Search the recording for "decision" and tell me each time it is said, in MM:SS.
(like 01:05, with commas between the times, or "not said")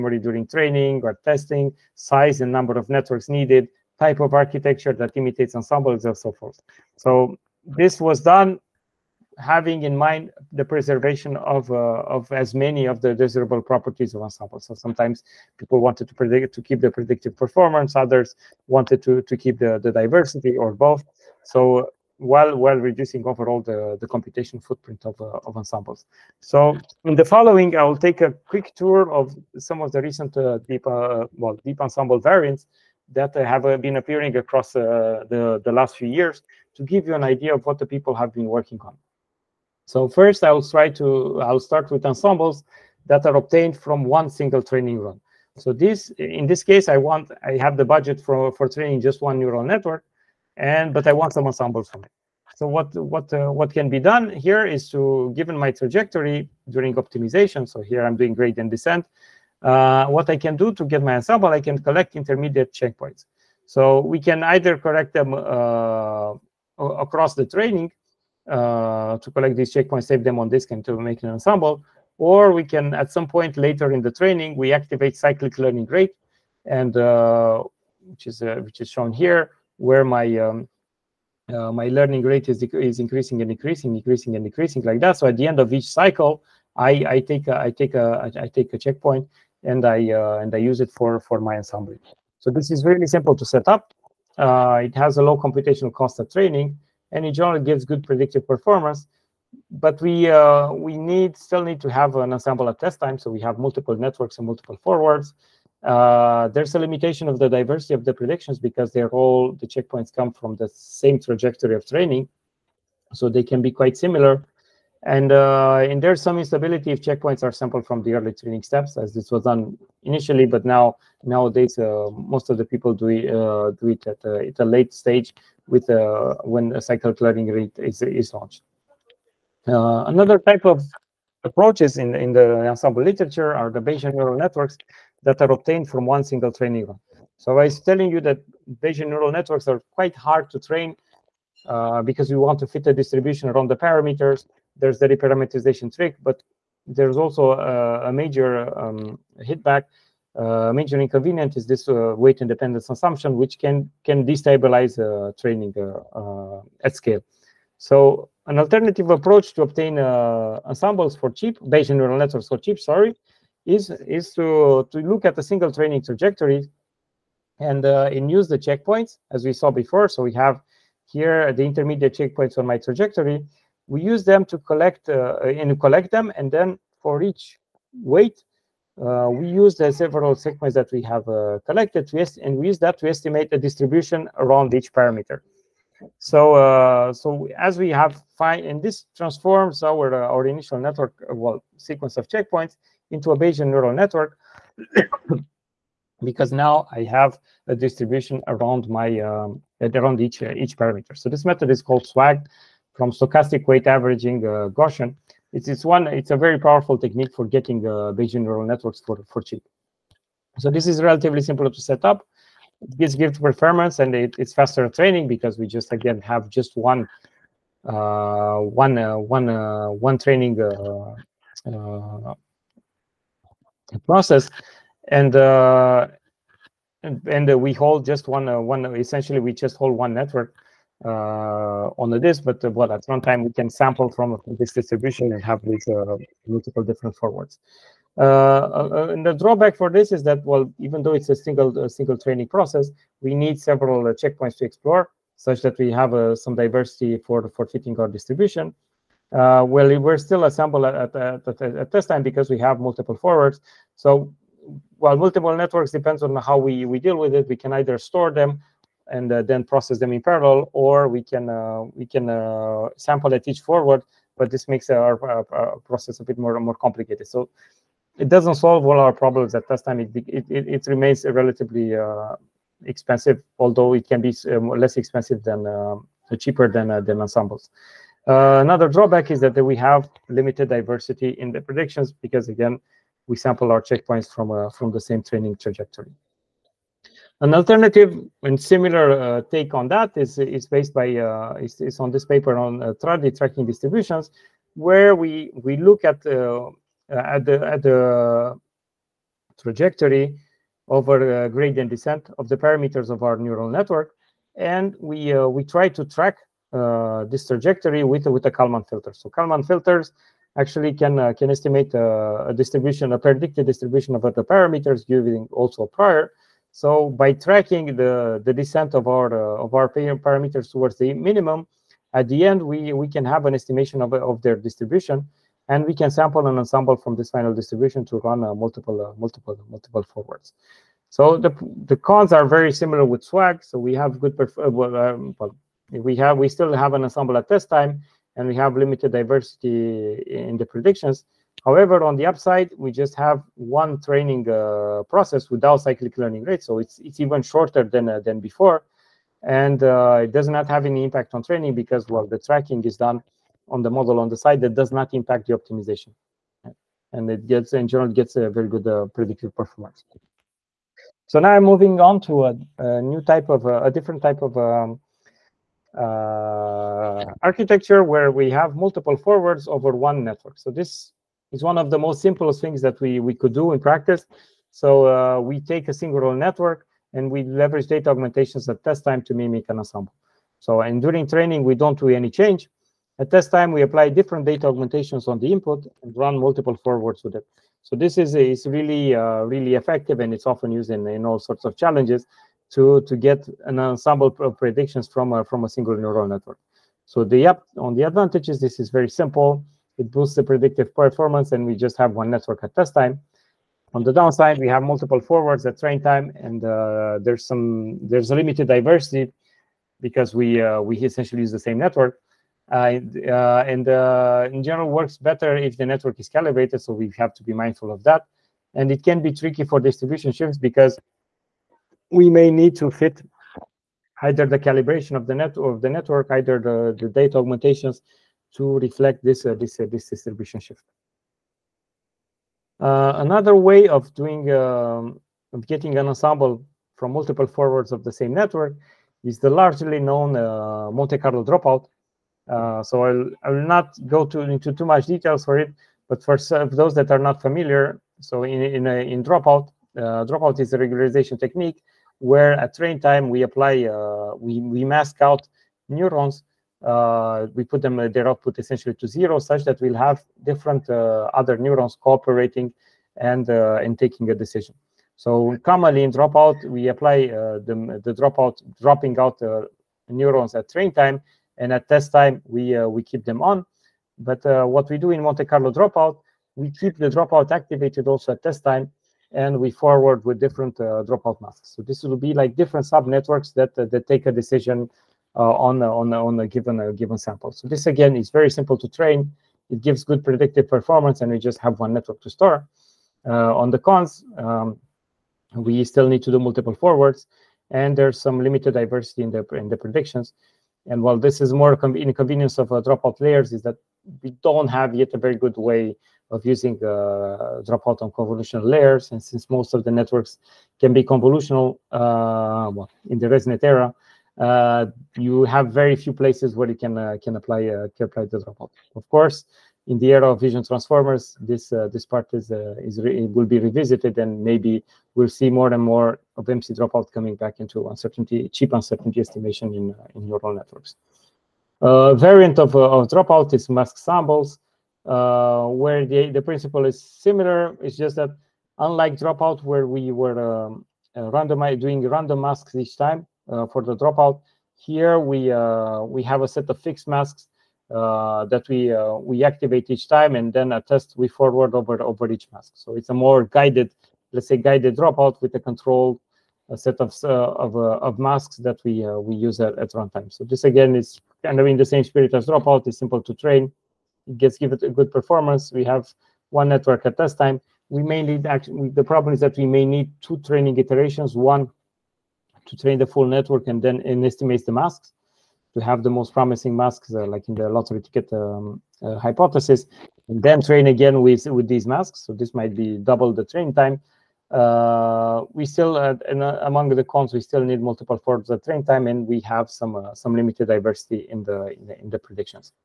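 07:44, 08:04.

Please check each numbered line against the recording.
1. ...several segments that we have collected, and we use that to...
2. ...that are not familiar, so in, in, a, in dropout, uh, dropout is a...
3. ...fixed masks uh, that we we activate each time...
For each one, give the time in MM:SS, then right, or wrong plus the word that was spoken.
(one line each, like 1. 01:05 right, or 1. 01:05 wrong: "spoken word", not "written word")
1. 02:59 right
2. 07:26 right
3. 09:06 right.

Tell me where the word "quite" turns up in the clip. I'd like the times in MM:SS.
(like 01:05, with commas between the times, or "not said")
01:53, 02:19.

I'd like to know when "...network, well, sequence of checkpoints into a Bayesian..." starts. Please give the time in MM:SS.
03:10.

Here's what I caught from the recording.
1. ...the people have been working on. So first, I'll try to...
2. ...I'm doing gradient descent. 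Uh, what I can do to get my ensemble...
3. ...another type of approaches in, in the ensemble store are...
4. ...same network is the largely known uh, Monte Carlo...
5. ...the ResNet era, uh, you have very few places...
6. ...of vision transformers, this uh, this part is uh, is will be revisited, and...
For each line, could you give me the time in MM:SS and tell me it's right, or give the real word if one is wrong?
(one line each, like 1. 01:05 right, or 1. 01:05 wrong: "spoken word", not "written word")
1. 00:37 right
2. 00:58 right
3. 02:10 wrong: "literature", not "store"
4. 07:18 right
5. 08:33 right
6. 08:40 right.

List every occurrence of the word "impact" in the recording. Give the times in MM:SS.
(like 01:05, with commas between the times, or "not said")
05:51, 05:55.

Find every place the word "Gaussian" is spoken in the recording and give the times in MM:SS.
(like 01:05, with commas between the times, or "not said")
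03:24.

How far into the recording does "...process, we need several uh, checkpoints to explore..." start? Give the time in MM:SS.
04:02.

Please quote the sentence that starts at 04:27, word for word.
So it doesn't solve all our problems at test time.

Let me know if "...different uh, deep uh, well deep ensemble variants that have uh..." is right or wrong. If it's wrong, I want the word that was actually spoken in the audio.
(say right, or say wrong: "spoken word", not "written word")
wrong: "recent", not "different".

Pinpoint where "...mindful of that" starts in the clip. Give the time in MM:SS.
06:57.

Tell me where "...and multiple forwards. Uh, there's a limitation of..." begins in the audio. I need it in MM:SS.
01:44.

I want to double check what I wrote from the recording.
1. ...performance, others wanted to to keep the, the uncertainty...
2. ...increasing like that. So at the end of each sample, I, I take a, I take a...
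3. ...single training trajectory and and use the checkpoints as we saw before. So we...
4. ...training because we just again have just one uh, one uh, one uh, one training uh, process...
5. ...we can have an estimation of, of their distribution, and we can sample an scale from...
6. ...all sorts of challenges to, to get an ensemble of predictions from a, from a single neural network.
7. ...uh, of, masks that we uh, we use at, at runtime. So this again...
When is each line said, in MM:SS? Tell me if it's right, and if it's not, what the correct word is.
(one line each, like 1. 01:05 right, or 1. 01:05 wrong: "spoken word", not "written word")
1. 00:17 wrong: "diversity", not "uncertainty"
2. 01:24 wrong: "cycle", not "sample"
3. 02:45 right
4. 03:34 right
5. 05:22 wrong: "ensemble", not "scale"
6. 06:31 right
7. 09:17 right.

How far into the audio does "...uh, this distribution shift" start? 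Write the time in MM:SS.
07:09.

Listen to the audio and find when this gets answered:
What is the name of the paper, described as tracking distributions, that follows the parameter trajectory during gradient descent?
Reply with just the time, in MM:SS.
04:52.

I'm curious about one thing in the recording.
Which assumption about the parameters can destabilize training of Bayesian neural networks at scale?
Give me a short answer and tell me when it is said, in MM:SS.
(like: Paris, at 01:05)
Weight independence assumption, at 02:32.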